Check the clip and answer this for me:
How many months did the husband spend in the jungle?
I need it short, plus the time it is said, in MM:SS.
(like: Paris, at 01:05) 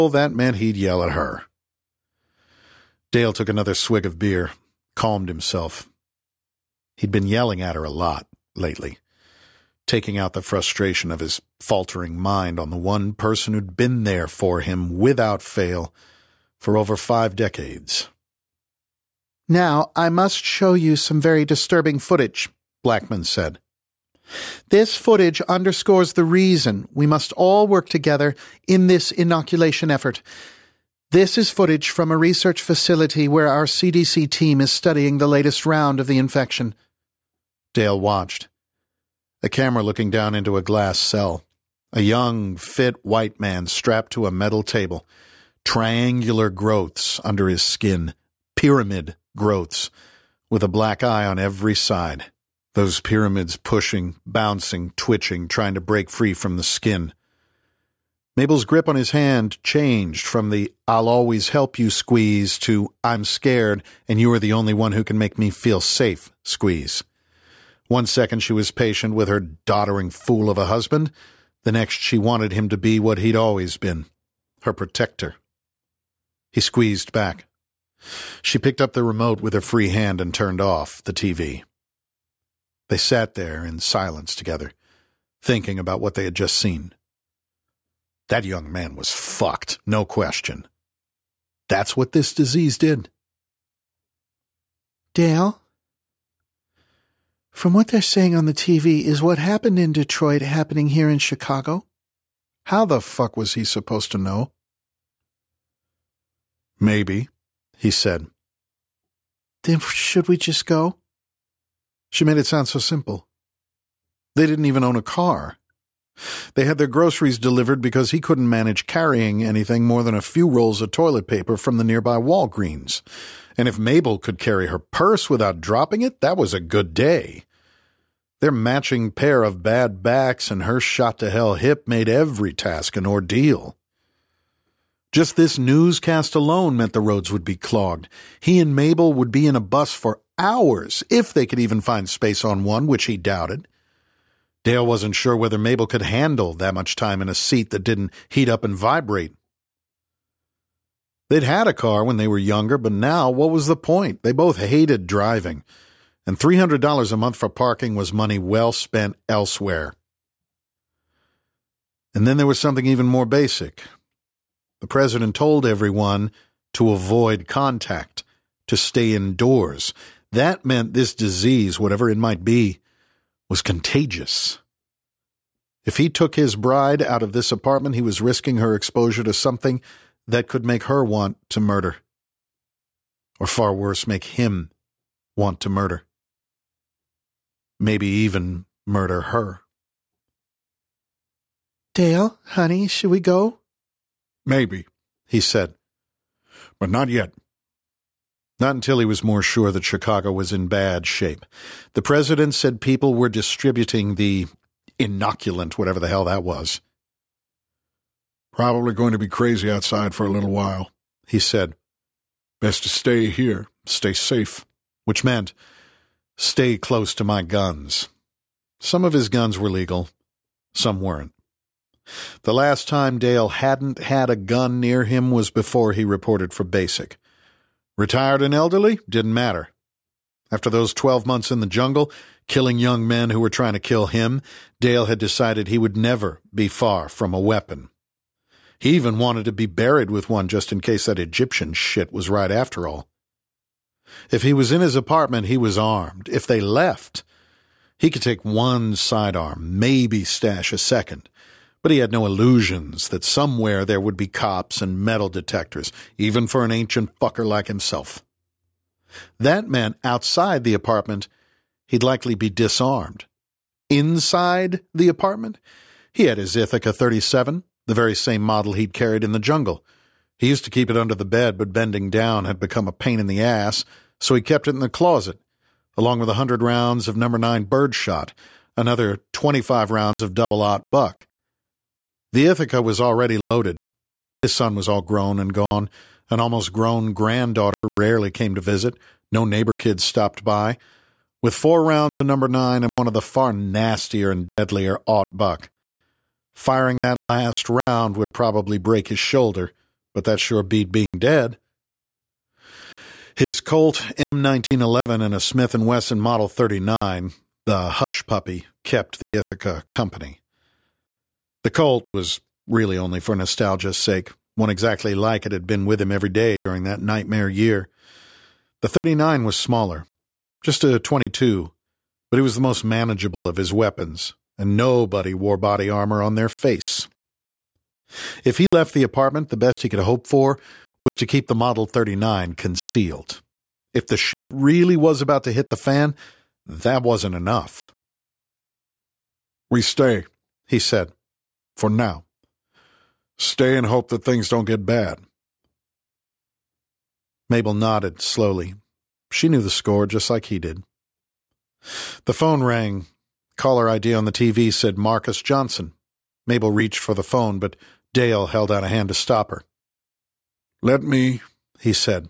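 12, at 03:50.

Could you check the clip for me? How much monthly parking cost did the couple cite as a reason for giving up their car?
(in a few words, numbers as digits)
$300.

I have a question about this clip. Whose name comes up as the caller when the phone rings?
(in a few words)
Marcus Johnson.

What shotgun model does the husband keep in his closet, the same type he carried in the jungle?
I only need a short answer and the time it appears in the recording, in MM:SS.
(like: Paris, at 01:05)
Ithaca 37, at 04:26.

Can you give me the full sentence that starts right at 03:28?
Probably going to be crazy outside for a little while, he said.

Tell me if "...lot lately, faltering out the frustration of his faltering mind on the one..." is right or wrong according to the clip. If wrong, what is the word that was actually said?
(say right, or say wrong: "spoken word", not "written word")
wrong: "taking", not "faltering".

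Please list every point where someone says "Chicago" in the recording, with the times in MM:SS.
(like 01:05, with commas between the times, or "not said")
01:41, 03:19.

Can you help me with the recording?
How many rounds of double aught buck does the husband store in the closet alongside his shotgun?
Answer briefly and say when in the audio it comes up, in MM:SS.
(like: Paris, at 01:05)
25, at 04:39.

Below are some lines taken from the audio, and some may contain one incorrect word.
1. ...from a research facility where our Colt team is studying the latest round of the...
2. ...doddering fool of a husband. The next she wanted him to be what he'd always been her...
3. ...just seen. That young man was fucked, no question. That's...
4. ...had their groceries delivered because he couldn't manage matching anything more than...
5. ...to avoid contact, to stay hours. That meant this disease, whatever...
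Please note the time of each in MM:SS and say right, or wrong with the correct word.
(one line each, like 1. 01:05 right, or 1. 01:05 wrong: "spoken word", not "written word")
1. 00:31 wrong: "CDC", not "Colt"
2. 01:09 right
3. 01:26 right
4. 01:56 wrong: "carrying", not "matching"
5. 02:46 wrong: "indoors", not "hours".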